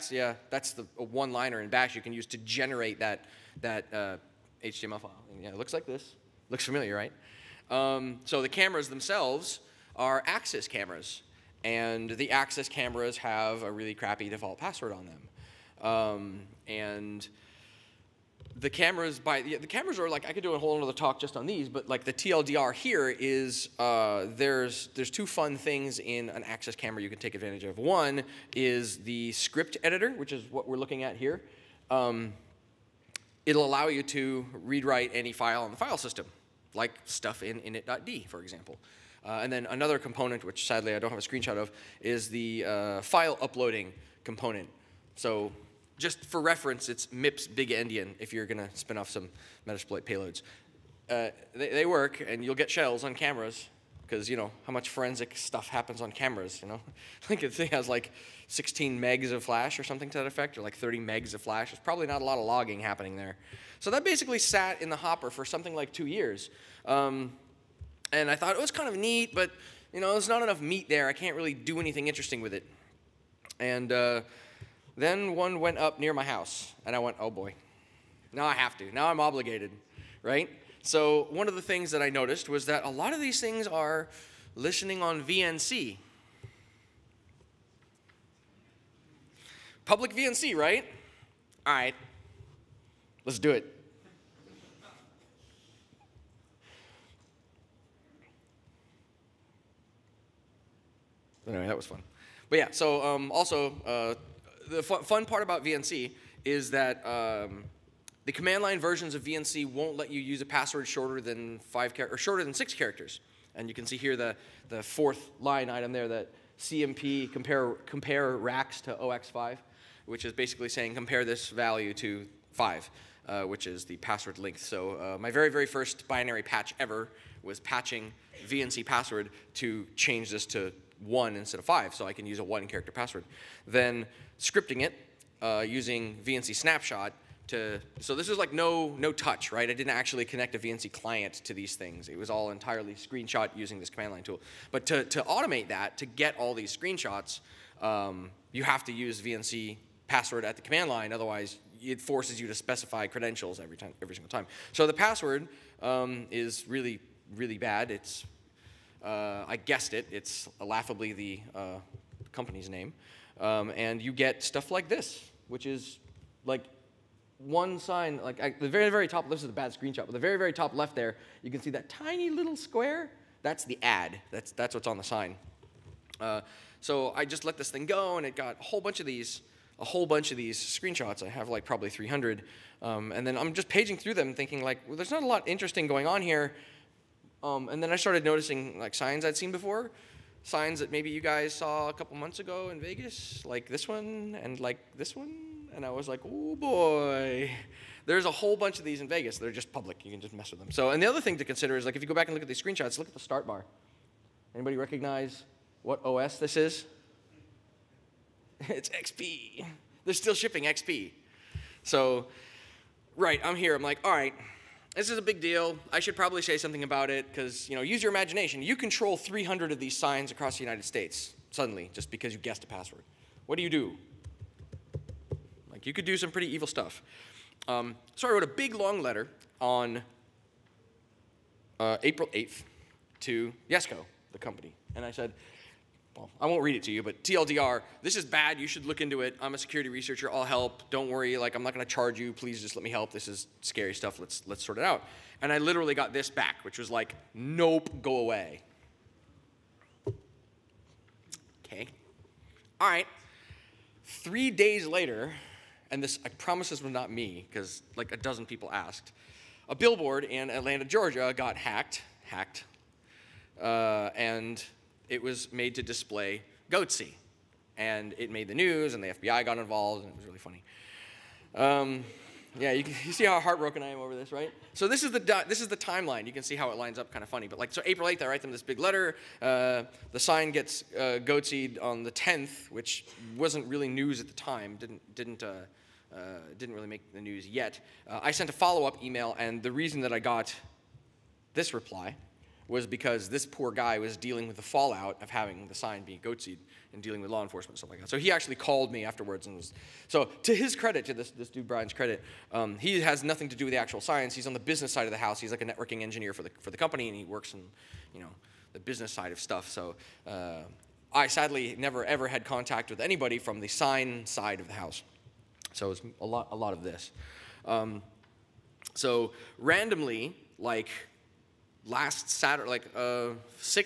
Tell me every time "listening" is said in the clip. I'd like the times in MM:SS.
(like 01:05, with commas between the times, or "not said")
01:24.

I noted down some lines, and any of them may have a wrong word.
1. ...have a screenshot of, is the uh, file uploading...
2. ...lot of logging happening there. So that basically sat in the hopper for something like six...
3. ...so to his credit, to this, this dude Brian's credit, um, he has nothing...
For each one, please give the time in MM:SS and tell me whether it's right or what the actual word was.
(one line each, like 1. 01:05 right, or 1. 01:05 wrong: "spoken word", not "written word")
1. 00:41 right
2. 01:02 wrong: "two", not "six"
3. 05:00 right.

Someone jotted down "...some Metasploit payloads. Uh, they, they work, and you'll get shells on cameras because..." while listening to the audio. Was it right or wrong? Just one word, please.
right.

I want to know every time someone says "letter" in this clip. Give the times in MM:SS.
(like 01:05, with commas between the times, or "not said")
03:49, 04:38.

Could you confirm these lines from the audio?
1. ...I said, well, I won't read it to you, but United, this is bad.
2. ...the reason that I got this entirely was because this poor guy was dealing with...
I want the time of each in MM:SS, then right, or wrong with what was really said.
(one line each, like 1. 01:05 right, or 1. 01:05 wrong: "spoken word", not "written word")
1. 03:55 wrong: "TLDR", not "United"
2. 04:49 wrong: "reply", not "entirely".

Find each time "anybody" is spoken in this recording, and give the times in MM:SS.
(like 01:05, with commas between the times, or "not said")
03:24, 05:13.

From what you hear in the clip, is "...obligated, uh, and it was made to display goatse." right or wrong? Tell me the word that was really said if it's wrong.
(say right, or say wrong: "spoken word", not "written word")
wrong: "hacked", not "obligated".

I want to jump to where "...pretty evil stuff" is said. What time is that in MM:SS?
03:46.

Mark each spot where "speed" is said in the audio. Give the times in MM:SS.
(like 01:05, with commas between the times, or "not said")
not said.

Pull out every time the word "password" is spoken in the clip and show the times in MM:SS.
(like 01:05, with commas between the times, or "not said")
00:14, 01:50, 02:03, 02:08, 02:12, 02:30, 02:34, 03:42.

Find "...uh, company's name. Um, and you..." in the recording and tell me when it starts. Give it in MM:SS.
02:41.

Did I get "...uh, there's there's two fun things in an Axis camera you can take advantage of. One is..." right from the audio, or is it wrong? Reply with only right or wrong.
right.